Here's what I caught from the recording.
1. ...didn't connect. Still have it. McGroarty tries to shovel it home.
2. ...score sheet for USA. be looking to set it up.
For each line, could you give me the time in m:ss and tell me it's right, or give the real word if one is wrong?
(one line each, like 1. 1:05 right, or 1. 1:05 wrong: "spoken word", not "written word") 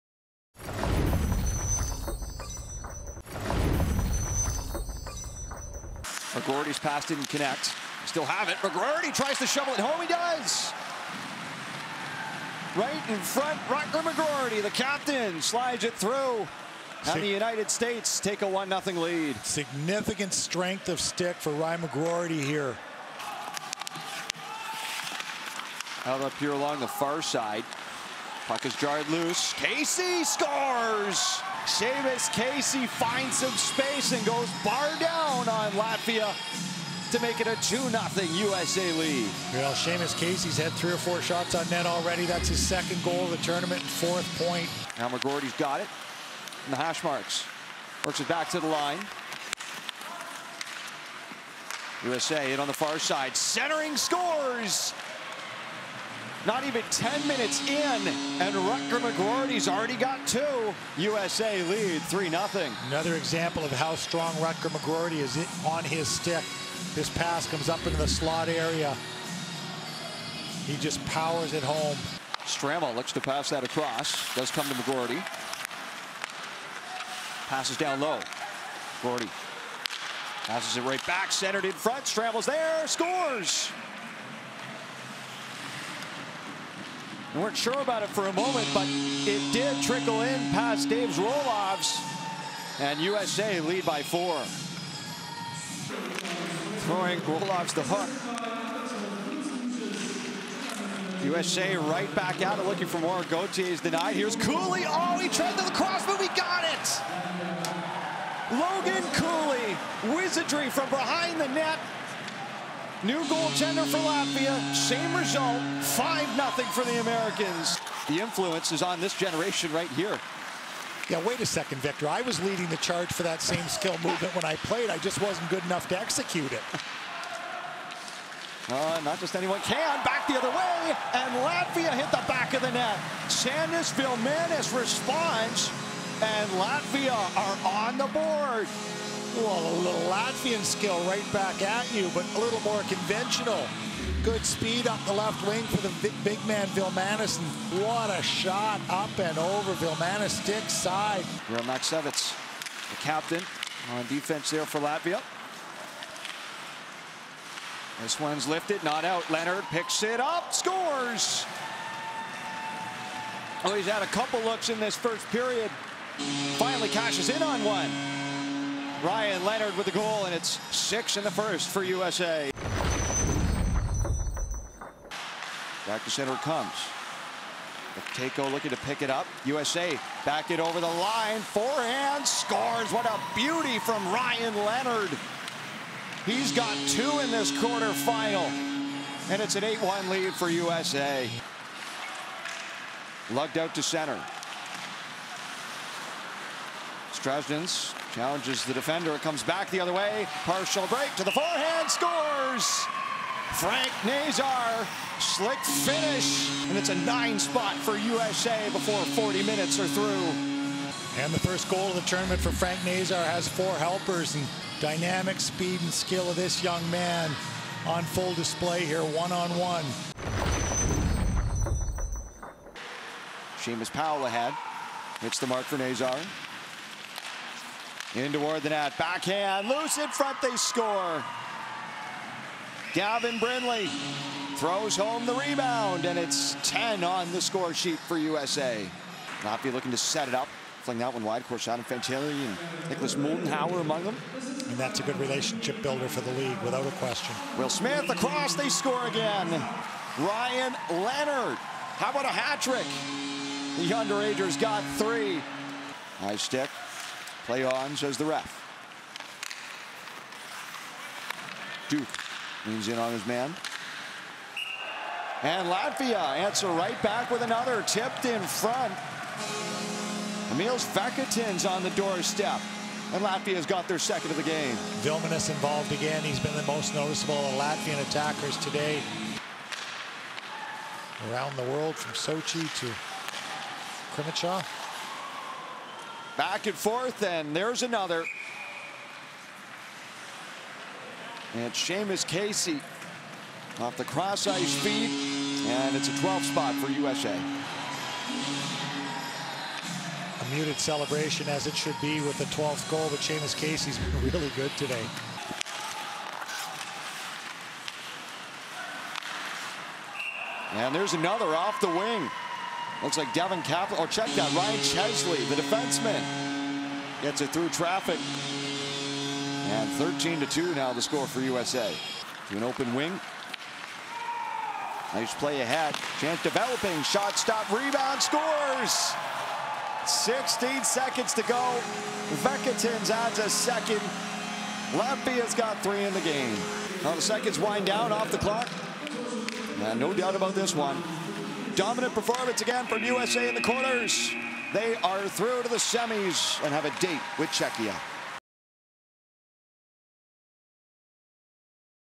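1. 0:07 right
2. 3:57 right.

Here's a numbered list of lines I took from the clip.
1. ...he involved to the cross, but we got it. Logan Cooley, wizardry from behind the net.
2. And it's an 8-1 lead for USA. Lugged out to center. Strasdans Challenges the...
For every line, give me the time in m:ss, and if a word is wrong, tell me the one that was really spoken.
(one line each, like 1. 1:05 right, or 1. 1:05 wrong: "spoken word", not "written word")
1. 1:45 wrong: "tried", not "involved"
2. 3:09 right.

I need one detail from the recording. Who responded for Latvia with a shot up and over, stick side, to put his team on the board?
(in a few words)
Sandis Vilmanis.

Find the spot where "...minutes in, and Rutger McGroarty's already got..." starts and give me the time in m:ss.
0:57.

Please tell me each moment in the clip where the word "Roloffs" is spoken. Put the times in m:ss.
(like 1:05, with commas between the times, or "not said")
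1:31, 1:37.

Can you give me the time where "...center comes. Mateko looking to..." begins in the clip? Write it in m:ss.
2:56.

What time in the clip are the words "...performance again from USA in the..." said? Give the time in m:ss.
5:42.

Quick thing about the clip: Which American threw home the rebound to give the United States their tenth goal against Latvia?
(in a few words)
Gavin Brindley.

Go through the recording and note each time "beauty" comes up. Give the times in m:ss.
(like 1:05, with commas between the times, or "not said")
3:03.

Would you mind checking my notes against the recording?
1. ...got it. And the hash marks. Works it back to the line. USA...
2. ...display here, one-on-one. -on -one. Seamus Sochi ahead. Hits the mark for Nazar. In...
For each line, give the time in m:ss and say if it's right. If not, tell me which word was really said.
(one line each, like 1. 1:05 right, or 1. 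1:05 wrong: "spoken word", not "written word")
1. 0:45 right
2. 3:38 wrong: "Powell", not "Sochi".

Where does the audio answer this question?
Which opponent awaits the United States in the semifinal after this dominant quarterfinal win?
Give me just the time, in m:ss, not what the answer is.
5:47.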